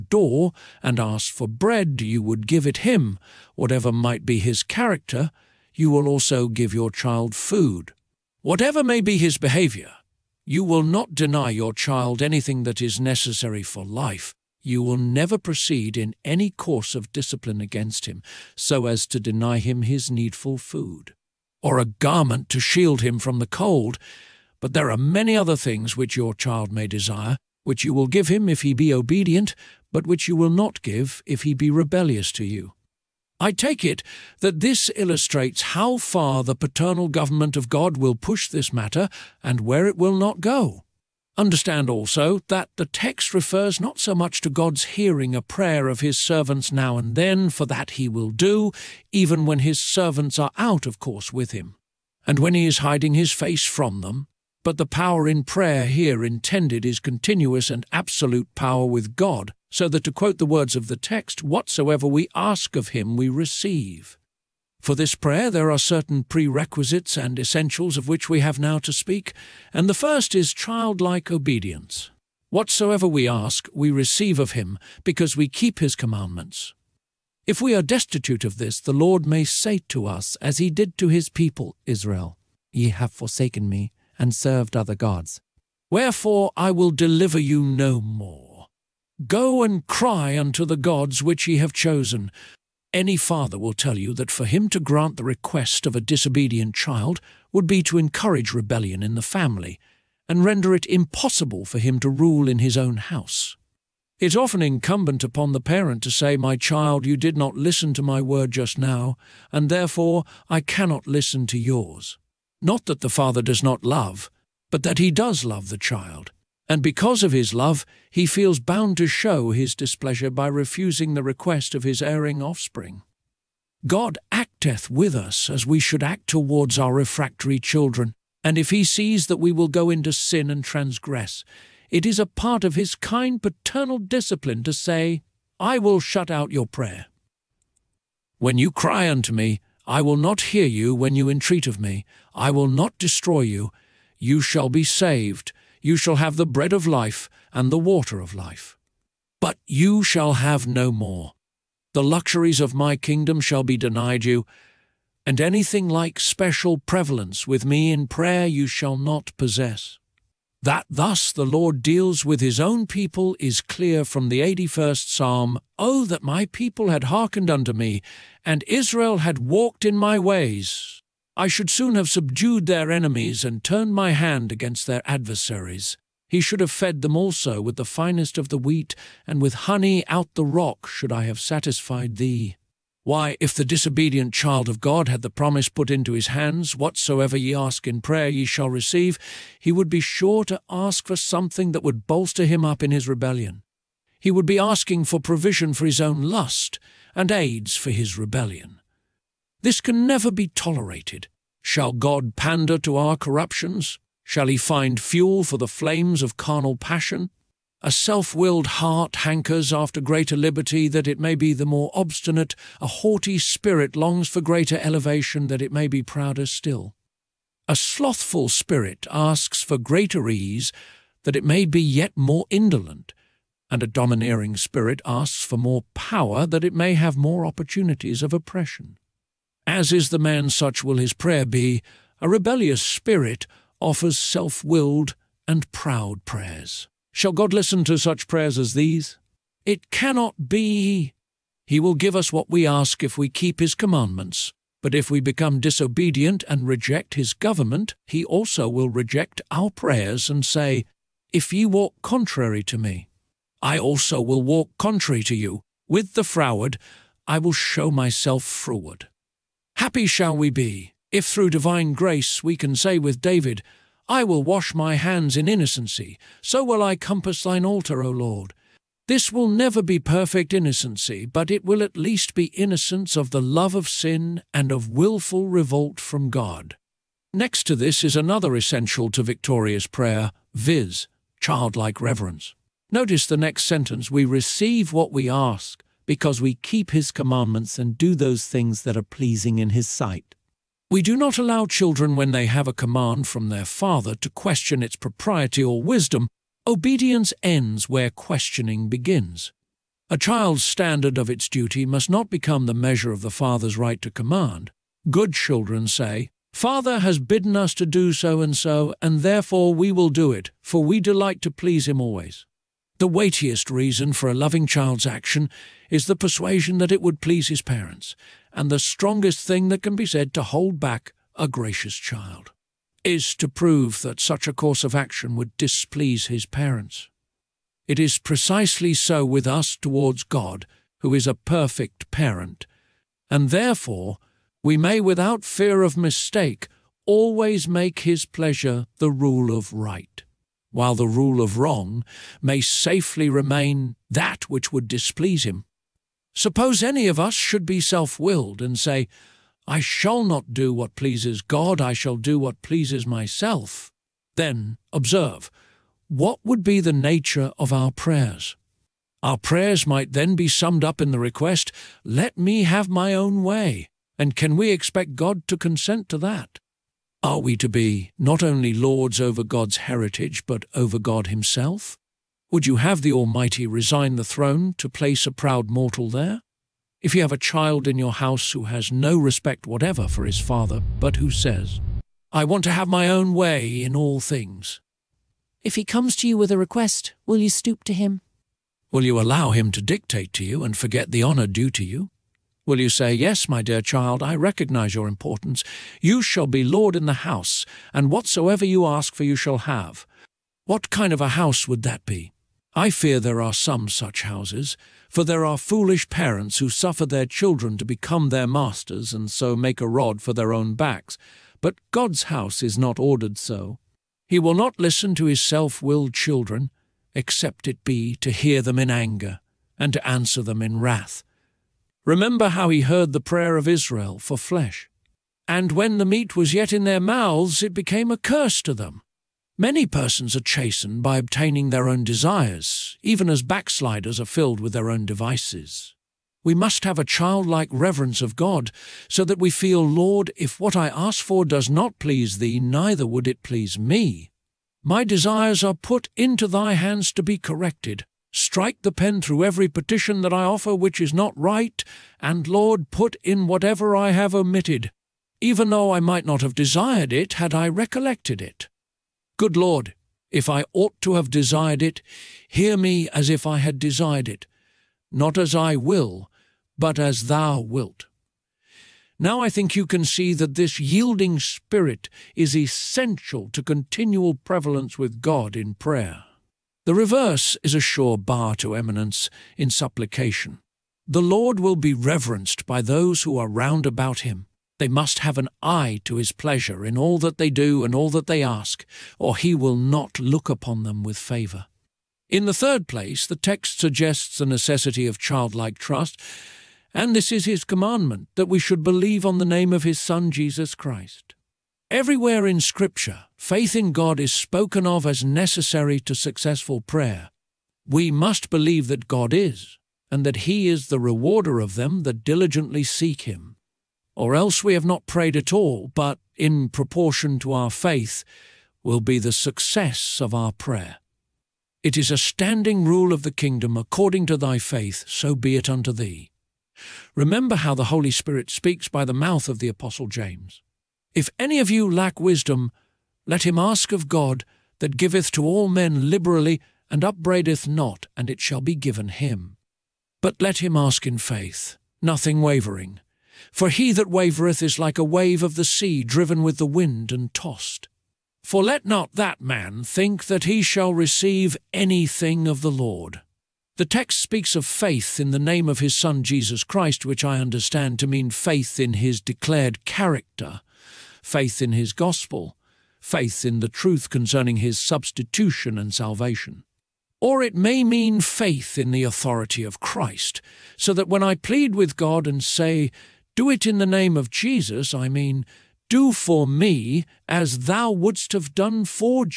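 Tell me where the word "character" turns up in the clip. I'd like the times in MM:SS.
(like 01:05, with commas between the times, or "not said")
00:04, 09:19.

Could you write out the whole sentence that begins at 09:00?
But let him ask in faith, nothing wavering.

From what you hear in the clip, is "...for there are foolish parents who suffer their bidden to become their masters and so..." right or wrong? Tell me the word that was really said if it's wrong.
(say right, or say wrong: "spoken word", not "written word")
wrong: "children", not "bidden".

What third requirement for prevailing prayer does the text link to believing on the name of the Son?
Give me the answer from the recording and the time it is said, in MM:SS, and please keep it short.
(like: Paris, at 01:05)
Childlike trust, at 08:15.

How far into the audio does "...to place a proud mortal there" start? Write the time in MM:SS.
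06:14.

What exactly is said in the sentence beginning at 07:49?
Now I think you can see that this yielding spirit is essential to continual prevalence with God in prayer.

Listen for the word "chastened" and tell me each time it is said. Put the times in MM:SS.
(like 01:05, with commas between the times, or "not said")
07:10.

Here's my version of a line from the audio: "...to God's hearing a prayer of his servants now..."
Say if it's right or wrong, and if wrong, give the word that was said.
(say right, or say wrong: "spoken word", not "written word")
right.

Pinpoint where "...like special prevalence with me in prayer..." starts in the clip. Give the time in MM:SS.
02:35.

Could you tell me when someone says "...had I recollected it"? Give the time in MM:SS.
07:37.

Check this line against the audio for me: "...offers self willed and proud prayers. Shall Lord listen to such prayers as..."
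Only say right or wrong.
wrong.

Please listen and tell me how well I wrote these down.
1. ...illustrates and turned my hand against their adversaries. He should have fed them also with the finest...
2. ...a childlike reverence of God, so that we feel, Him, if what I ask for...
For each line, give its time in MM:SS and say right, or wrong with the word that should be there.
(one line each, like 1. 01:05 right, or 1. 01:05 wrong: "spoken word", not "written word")
1. 02:52 wrong: "enemies", not "illustrates"
2. 07:16 wrong: "Lord", not "Him".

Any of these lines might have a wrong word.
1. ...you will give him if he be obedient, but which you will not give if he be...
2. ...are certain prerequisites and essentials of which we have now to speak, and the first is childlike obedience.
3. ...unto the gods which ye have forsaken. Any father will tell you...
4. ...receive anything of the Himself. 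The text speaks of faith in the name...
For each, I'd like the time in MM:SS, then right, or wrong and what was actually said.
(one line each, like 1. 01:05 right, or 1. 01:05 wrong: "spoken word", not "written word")
1. 00:27 right
2. 01:05 right
3. 01:30 wrong: "chosen", not "forsaken"
4. 09:10 wrong: "Lord", not "Himself".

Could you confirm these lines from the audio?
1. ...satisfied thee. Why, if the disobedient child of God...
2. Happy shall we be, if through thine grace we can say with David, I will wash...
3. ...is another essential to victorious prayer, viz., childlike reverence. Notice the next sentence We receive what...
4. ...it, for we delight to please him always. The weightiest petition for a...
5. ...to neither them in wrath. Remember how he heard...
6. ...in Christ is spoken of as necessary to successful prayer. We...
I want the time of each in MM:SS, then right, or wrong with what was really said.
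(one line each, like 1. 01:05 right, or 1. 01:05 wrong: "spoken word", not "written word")
1. 03:01 right
2. 04:19 wrong: "divine", not "thine"
3. 04:38 right
4. 05:10 wrong: "reason", not "petition"
5. 06:59 wrong: "answer", not "neither"
6. 08:23 wrong: "God", not "Christ".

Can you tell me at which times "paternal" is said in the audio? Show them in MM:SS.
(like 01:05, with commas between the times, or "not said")
00:36, 02:13.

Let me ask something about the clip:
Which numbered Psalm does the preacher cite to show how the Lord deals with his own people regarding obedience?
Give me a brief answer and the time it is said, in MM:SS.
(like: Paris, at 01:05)
81st Psalm, at 02:44.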